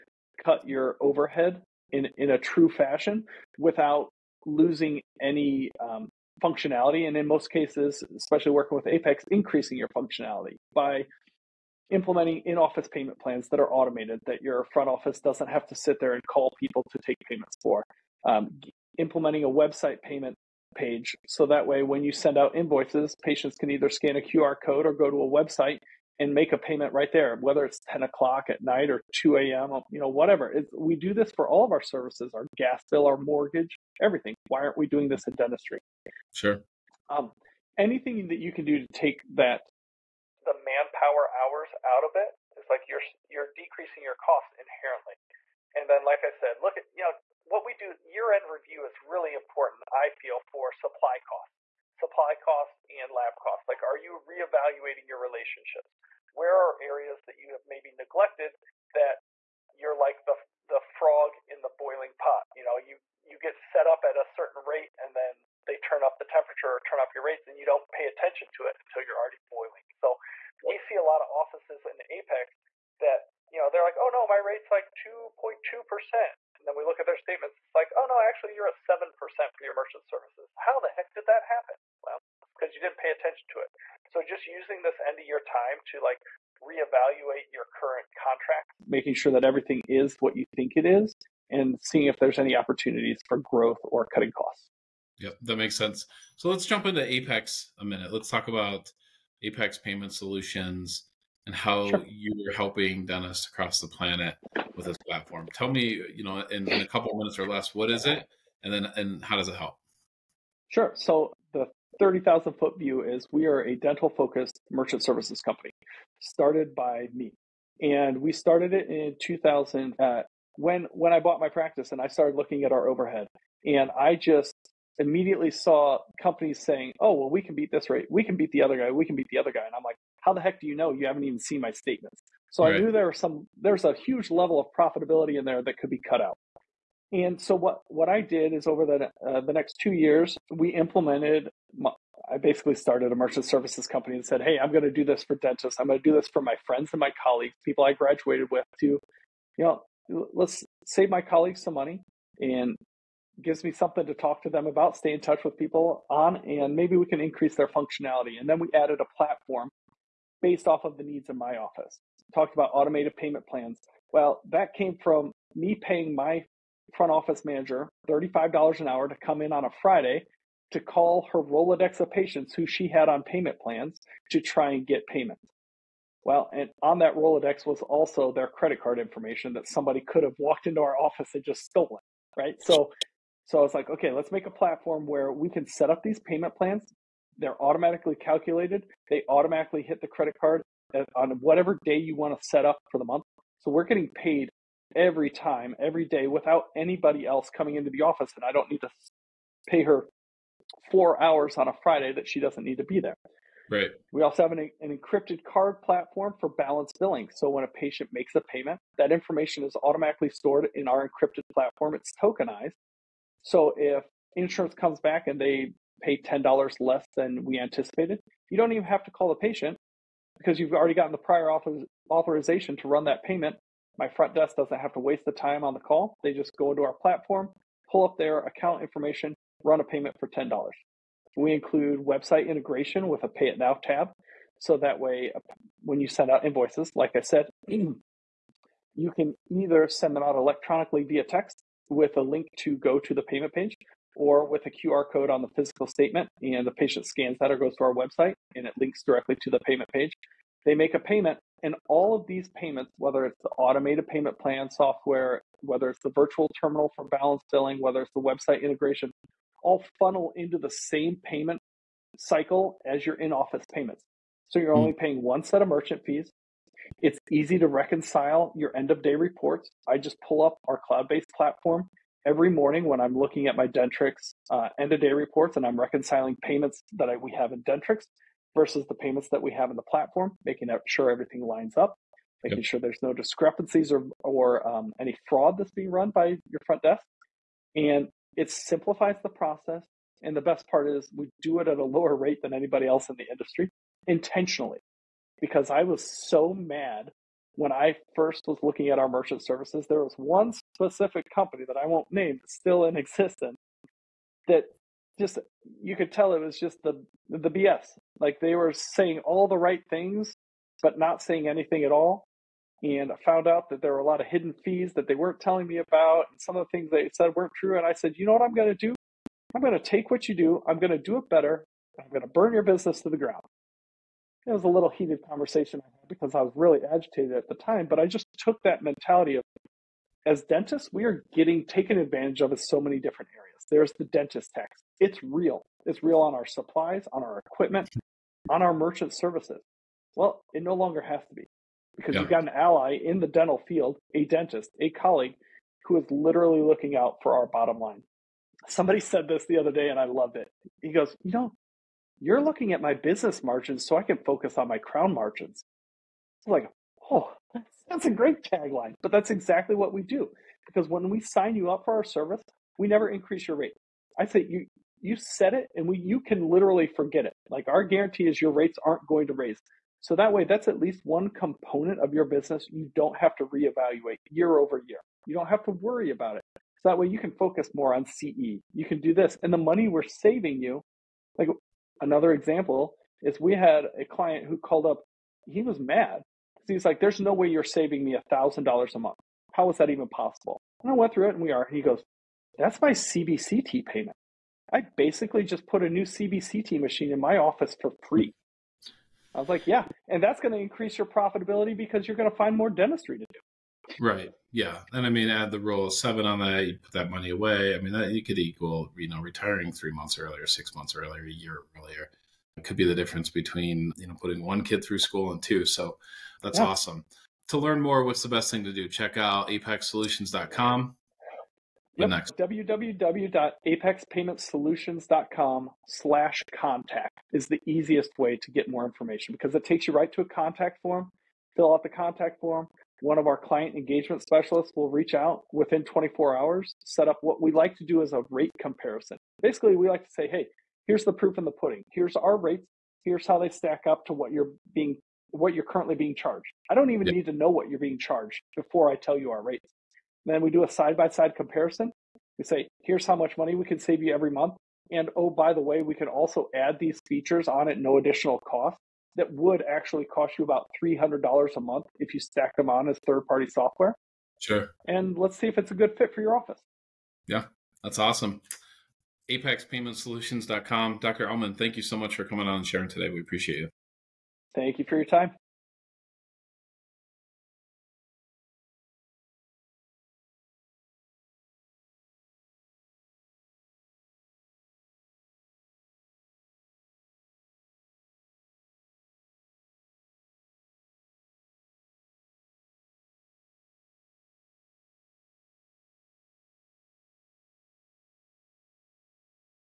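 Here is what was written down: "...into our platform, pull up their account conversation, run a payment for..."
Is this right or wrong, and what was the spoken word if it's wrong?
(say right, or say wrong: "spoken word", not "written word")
wrong: "information", not "conversation".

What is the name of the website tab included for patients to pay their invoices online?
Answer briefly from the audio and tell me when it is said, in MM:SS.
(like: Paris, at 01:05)
Pay It Now, at 03:53.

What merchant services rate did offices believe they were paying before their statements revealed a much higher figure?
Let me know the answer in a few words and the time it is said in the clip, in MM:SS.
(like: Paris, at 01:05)
2.2 percent, at 01:14.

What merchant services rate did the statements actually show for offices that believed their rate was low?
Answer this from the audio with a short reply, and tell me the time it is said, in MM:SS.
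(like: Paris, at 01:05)
7 percent, at 01:18.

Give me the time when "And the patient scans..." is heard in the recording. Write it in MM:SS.
04:06.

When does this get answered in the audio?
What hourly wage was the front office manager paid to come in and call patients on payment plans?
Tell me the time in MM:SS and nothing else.
02:48.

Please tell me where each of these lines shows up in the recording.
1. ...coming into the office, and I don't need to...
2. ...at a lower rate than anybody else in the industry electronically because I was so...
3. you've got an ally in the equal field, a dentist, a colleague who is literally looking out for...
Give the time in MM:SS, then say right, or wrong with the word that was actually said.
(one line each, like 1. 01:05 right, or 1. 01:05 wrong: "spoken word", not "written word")
1. 03:17 right
2. 04:51 wrong: "intentionally", not "electronically"
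3. 05:42 wrong: "dental", not "equal".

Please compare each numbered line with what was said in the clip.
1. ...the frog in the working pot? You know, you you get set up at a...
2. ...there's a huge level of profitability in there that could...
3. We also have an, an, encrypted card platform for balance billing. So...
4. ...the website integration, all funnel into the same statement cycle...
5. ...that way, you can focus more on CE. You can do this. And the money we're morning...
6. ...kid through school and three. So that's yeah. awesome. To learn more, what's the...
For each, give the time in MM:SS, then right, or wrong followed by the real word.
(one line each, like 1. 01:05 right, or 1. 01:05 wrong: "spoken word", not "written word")
1. 01:00 wrong: "boiling", not "working"
2. 02:13 right
3. 03:24 right
4. 04:18 wrong: "payment", not "statement"
5. 06:16 wrong: "saving", not "morning"
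6. 06:54 wrong: "two", not "three".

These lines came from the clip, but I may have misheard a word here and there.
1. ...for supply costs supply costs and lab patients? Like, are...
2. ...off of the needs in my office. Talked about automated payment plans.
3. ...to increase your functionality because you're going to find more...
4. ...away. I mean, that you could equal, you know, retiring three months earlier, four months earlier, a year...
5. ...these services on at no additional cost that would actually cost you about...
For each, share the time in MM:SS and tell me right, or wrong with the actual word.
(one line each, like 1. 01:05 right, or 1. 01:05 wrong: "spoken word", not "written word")
1. 00:50 wrong: "costs", not "patients"
2. 02:40 right
3. 06:40 wrong: "profitability", not "functionality"
4. 06:47 wrong: "six", not "four"
5. 07:36 wrong: "features", not "services".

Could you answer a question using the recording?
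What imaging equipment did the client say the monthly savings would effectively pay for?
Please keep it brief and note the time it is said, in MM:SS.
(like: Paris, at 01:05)
CBCT machine, at 06:36.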